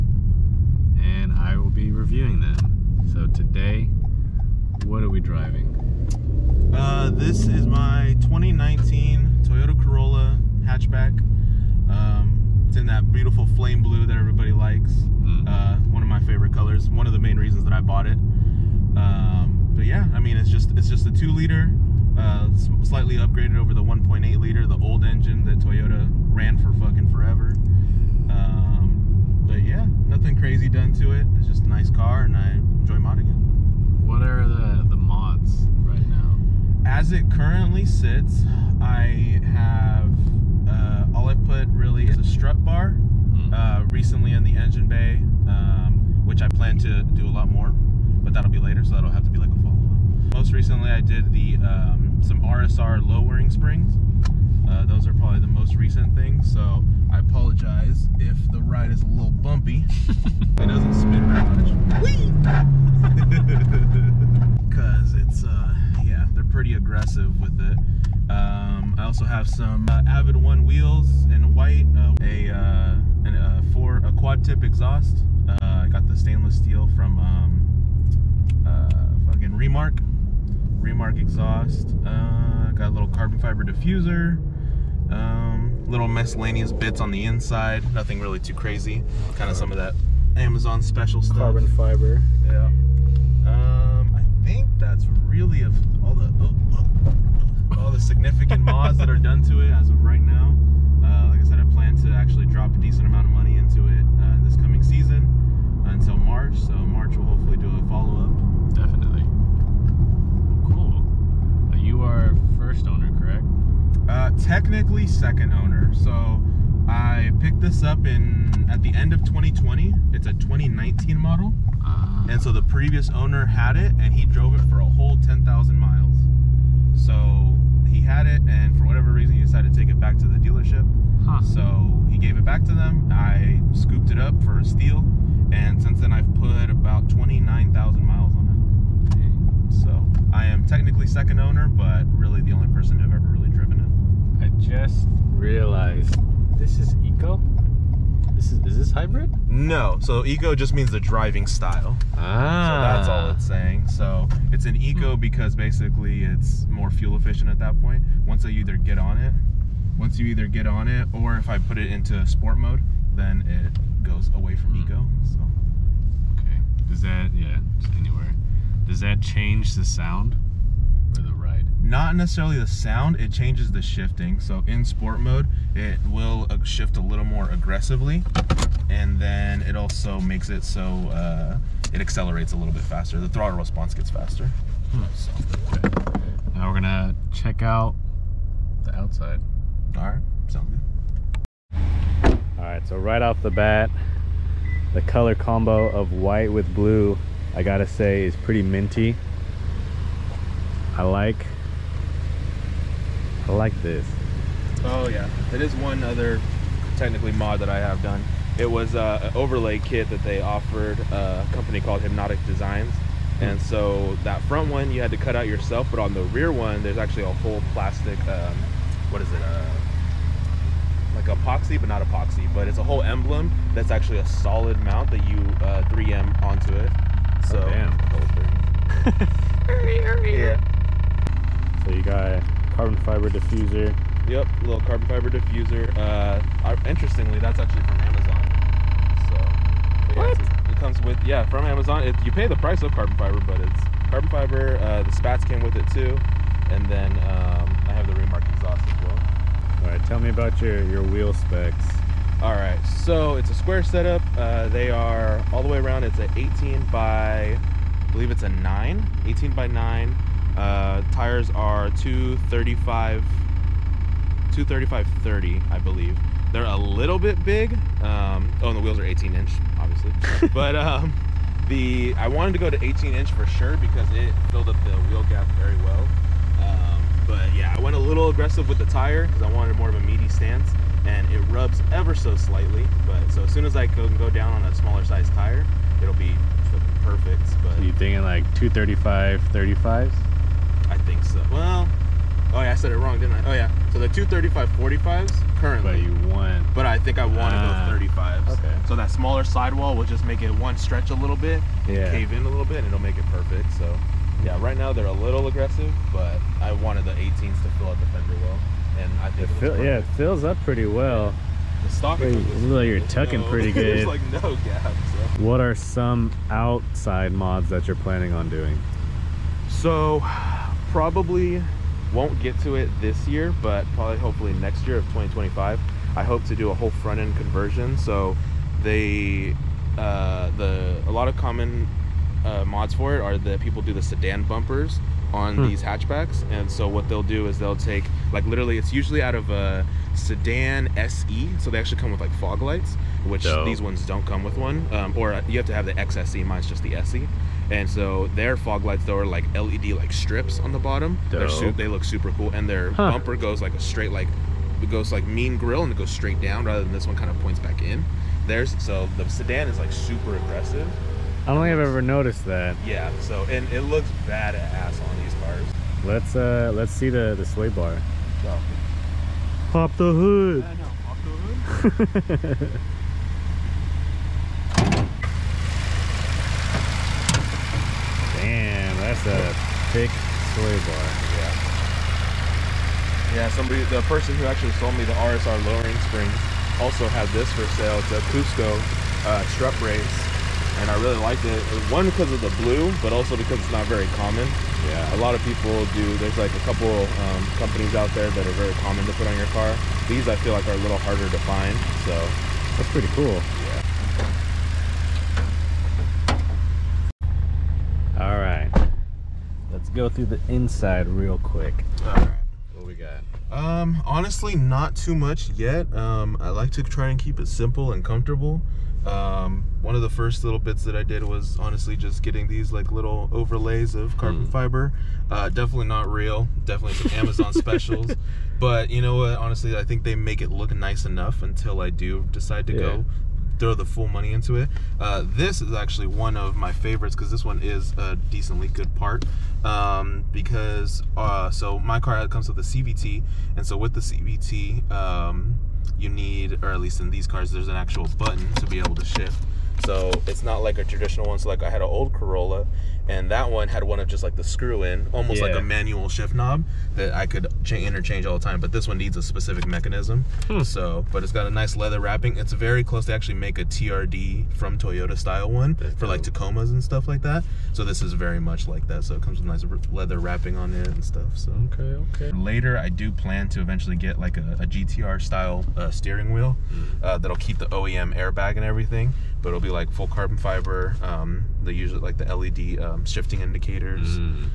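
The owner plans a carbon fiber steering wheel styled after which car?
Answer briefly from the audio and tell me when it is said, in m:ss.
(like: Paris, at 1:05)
GTR, at 7:54.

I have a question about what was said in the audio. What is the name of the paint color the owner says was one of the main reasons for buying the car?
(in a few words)
flame blue.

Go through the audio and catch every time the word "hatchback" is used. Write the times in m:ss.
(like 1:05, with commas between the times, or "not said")
0:10, 5:35.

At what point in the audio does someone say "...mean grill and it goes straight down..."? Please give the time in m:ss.
5:55.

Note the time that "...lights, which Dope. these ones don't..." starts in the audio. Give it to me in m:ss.
5:42.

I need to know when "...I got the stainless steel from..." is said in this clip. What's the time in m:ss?
1:15.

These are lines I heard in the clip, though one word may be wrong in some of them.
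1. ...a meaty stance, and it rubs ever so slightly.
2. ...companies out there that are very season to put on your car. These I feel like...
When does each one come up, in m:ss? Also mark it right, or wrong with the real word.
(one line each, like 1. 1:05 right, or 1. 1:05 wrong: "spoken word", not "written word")
1. 4:39 right
2. 6:37 wrong: "common", not "season".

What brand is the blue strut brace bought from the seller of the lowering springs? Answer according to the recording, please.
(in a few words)
Cusco.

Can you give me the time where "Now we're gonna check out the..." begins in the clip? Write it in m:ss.
3:06.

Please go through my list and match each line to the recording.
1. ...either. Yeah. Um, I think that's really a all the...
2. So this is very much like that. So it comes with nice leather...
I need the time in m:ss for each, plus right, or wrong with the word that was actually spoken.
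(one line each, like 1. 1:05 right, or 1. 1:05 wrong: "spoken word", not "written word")
1. 1:31 wrong: "fiber", not "either"
2. 7:47 right.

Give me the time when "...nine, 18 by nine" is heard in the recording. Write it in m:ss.
4:18.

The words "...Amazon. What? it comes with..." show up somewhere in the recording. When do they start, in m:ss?
3:57.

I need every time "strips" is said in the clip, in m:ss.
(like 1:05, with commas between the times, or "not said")
5:50.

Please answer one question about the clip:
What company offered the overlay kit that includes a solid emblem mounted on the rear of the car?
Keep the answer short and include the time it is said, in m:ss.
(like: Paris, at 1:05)
Hypnotic Designs, at 3:32.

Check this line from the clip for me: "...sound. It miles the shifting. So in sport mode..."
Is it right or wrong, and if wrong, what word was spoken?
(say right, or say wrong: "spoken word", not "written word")
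wrong: "changes", not "miles".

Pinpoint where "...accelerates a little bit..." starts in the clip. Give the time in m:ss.
3:02.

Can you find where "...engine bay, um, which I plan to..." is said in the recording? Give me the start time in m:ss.
0:44.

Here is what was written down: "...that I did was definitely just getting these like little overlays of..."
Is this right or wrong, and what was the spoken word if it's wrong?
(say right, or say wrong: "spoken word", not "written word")
wrong: "honestly", not "definitely".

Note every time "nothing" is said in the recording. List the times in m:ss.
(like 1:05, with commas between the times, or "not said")
0:30, 1:27.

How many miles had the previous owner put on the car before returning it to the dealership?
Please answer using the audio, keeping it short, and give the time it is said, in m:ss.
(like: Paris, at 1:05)
10,000, at 2:05.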